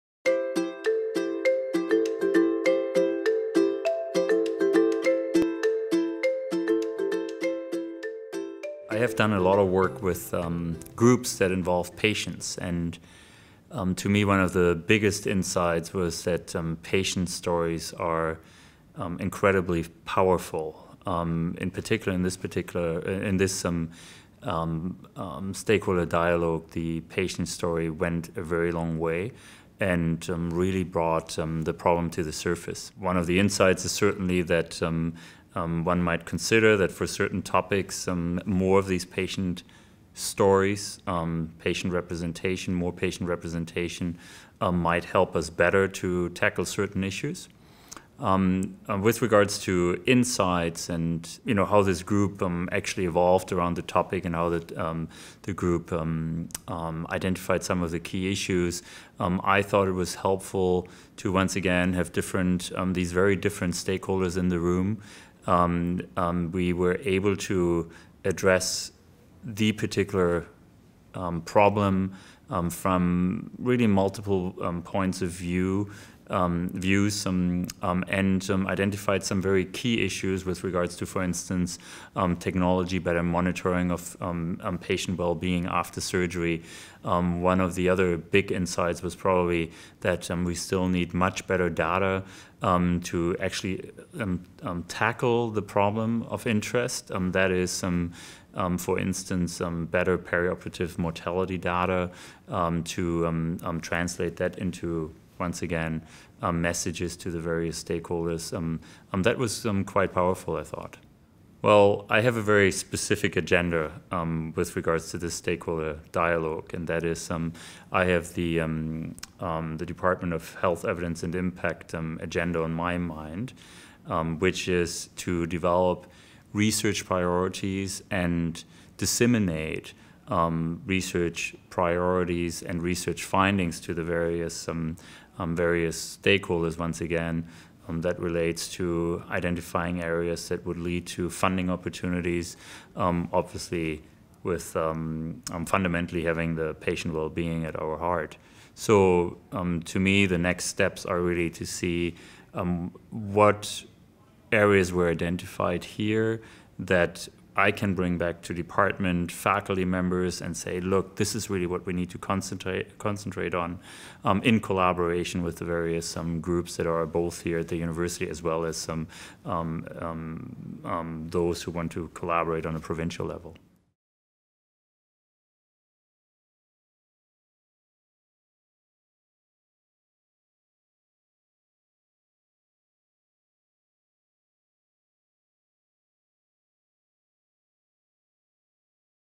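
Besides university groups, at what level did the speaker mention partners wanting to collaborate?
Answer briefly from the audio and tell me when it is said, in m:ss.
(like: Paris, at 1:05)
provincial level, at 2:52.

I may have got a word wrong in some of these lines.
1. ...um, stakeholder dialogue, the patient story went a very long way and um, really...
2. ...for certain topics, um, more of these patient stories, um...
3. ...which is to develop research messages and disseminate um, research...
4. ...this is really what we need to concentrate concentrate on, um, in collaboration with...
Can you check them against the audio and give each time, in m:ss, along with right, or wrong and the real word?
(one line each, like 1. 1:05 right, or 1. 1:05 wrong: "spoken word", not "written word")
1. 0:23 right
2. 0:36 right
3. 2:04 wrong: "priorities", not "messages"
4. 2:41 right.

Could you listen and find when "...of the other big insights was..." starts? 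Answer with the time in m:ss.
1:27.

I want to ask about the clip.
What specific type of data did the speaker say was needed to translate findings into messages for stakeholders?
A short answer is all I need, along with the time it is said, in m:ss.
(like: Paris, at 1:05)
perioperative mortality data, at 1:40.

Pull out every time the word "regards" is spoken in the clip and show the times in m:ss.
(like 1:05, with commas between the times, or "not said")
0:49, 1:20, 1:54.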